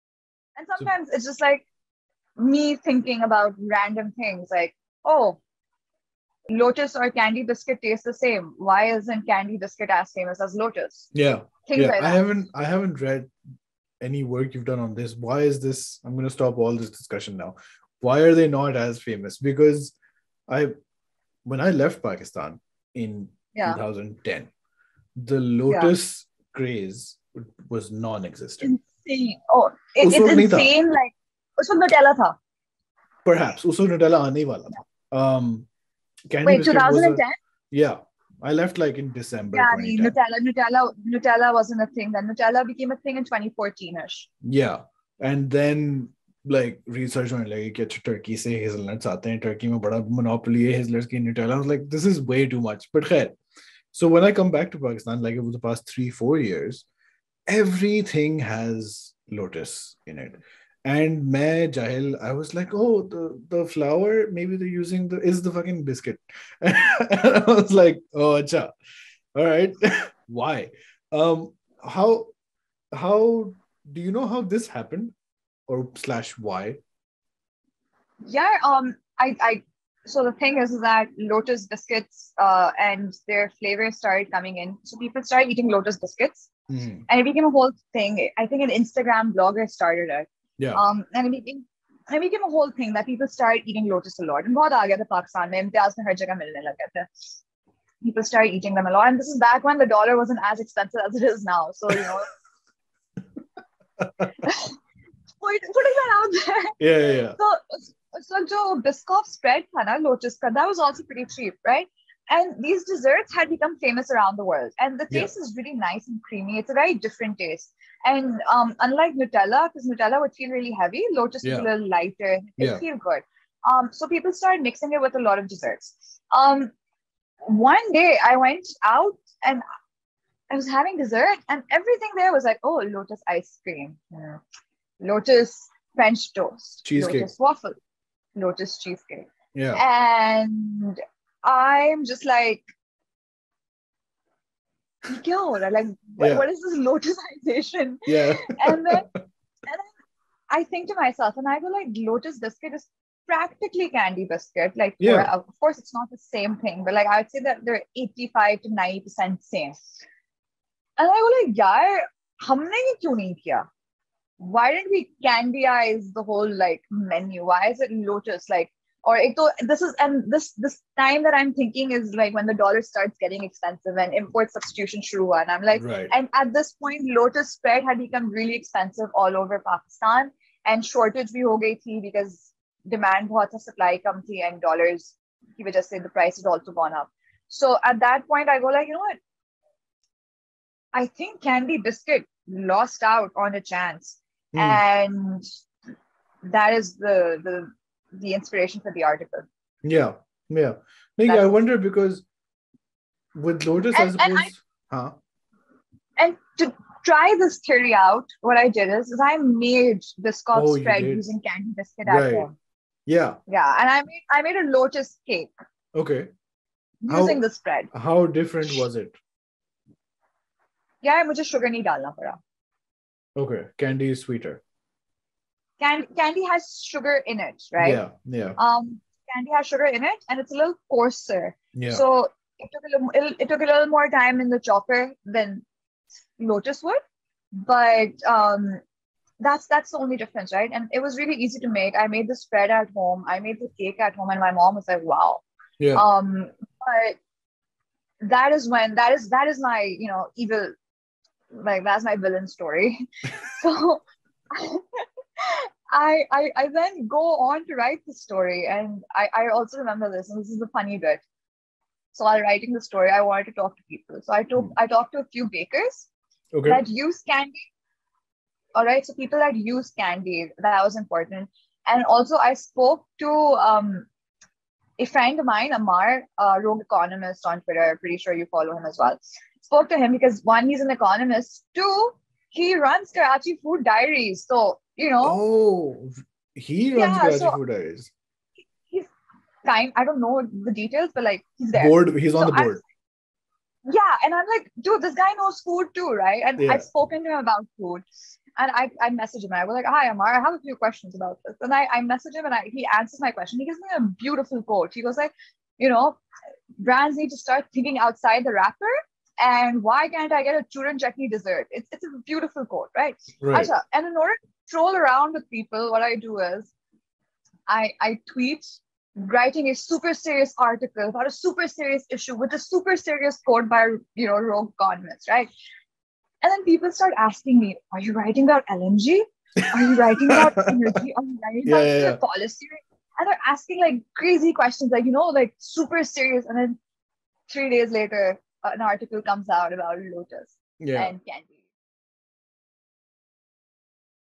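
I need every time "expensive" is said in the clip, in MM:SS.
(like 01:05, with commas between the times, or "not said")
01:40, 02:53, 02:58.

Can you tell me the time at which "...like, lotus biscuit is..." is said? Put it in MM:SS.
02:31.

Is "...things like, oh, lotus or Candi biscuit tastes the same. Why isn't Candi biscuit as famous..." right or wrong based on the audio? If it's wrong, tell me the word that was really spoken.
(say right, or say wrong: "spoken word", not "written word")
right.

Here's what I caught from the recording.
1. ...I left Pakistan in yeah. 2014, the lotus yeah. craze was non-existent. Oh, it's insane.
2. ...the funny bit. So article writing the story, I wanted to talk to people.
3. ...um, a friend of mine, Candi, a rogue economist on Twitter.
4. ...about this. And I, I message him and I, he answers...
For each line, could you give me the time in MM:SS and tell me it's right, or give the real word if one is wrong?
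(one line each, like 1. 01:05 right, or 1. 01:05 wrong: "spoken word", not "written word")
1. 00:21 wrong: "2010", not "2014"
2. 04:20 wrong: "while", not "article"
3. 04:33 wrong: "Amar", not "Candi"
4. 05:01 right.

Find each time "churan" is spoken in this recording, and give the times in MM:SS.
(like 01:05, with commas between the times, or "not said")
05:10.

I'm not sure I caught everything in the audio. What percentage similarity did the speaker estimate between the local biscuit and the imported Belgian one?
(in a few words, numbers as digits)
85 to 90 percent.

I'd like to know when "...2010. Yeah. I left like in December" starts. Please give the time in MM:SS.
00:36.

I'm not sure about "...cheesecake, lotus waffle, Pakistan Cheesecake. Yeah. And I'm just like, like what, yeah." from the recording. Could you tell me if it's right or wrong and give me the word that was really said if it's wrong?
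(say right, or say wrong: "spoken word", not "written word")
wrong: "Lotus", not "Pakistan".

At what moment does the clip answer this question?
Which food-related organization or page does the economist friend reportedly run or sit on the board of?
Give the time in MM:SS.
04:43.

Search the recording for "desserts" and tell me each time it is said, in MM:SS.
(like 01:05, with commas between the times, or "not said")
01:52, 02:05, 02:10, 05:11.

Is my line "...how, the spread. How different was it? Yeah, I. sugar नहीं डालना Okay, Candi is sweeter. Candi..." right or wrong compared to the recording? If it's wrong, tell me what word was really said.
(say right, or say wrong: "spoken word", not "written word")
right.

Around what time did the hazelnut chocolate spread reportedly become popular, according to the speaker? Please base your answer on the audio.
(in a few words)
2014.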